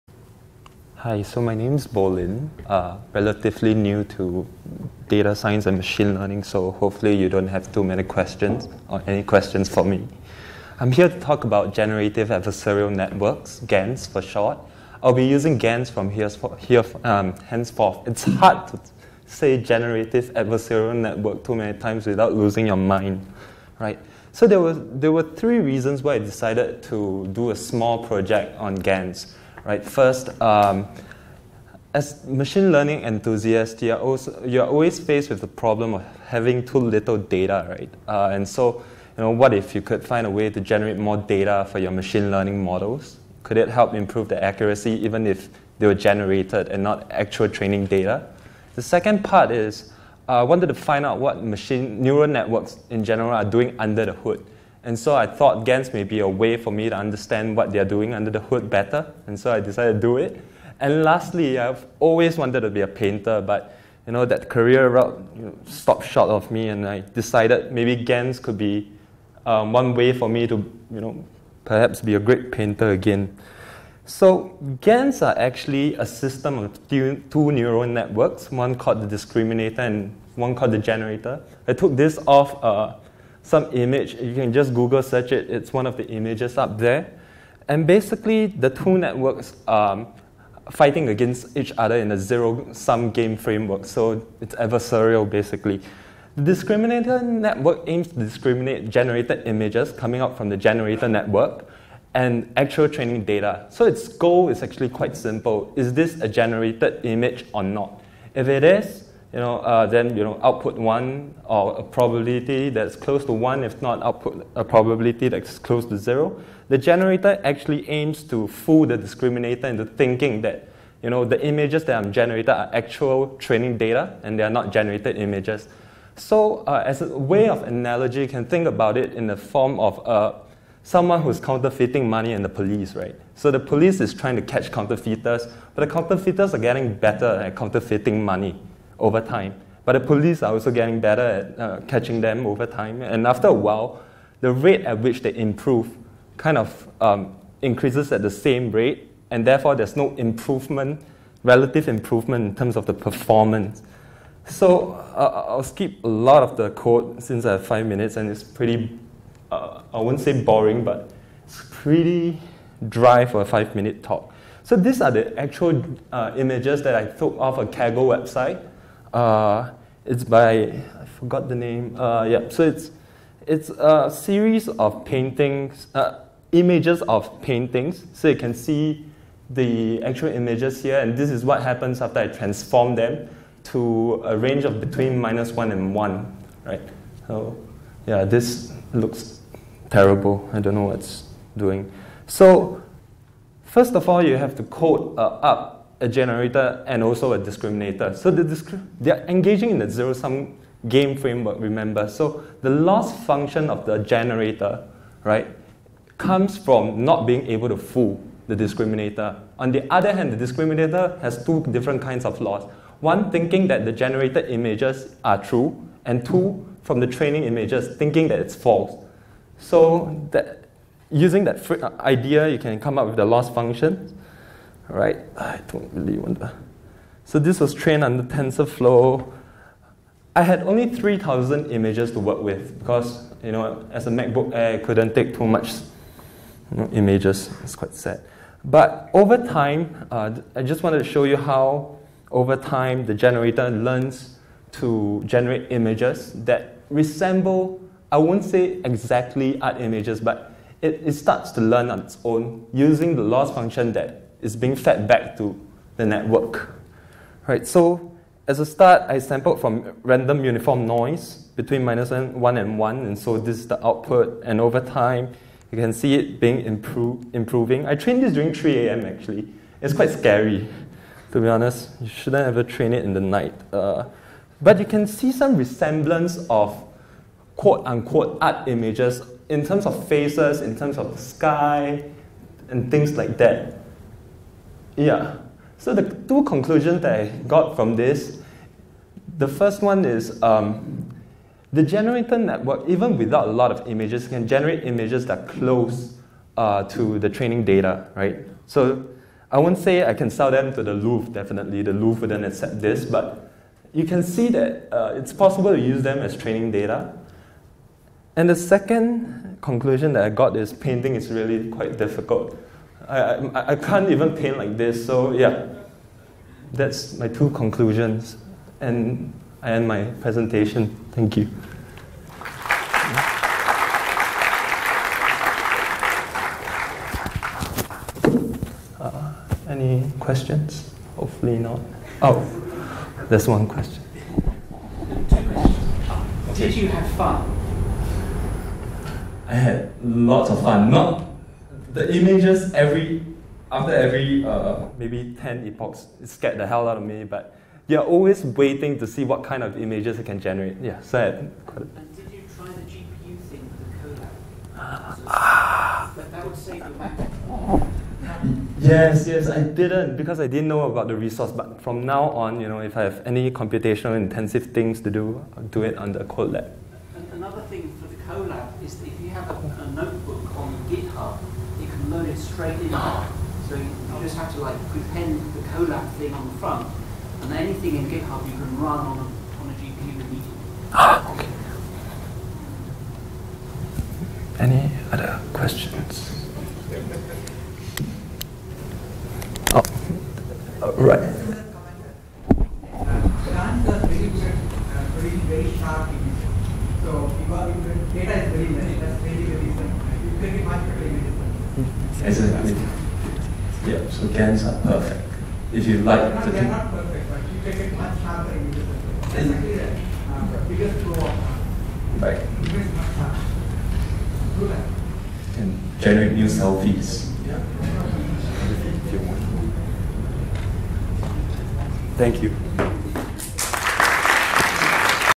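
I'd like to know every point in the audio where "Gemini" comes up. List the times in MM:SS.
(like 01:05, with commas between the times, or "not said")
not said.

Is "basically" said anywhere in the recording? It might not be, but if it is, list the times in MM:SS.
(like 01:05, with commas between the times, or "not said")
01:27, 01:35, 06:49.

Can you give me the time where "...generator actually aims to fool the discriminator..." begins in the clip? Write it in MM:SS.
01:56.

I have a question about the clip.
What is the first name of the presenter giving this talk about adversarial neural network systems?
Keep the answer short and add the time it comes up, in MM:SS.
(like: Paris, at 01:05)
Bolin, at 00:01.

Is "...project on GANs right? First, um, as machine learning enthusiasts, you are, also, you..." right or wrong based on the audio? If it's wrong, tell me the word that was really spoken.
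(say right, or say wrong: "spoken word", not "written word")
right.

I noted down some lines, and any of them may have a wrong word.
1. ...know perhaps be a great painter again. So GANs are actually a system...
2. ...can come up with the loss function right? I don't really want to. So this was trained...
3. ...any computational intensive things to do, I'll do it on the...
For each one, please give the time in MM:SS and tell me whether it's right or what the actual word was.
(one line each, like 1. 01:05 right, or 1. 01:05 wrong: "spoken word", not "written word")
1. 01:11 right
2. 03:42 right
3. 06:03 right.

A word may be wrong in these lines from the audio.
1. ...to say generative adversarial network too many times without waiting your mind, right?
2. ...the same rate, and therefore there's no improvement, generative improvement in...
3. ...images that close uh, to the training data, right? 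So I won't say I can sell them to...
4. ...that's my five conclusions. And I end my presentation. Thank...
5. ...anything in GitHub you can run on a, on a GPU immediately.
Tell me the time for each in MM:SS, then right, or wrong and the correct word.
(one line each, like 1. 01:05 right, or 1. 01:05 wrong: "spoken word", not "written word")
1. 00:18 wrong: "losing", not "waiting"
2. 02:28 wrong: "relative", not "generative"
3. 04:54 right
4. 05:16 wrong: "two", not "five"
5. 06:17 right.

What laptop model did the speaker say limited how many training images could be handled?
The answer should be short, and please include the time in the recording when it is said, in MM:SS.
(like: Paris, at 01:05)
MacBook Air, at 03:54.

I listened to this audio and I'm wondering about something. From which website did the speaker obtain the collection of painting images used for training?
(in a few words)
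Kaggle.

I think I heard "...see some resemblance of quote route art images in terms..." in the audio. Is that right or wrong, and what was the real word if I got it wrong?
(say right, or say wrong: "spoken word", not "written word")
wrong: "unquote", not "route".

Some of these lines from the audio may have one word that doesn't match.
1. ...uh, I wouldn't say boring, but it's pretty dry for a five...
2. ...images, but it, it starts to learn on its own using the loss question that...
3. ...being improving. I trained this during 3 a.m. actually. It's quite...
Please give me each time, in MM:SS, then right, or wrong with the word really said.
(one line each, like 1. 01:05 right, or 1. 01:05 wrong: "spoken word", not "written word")
1. 02:39 right
2. 04:09 wrong: "function", not "question"
3. 04:26 right.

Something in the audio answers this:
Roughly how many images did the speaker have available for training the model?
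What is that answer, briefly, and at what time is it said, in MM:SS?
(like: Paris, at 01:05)
3,000, at 03:50.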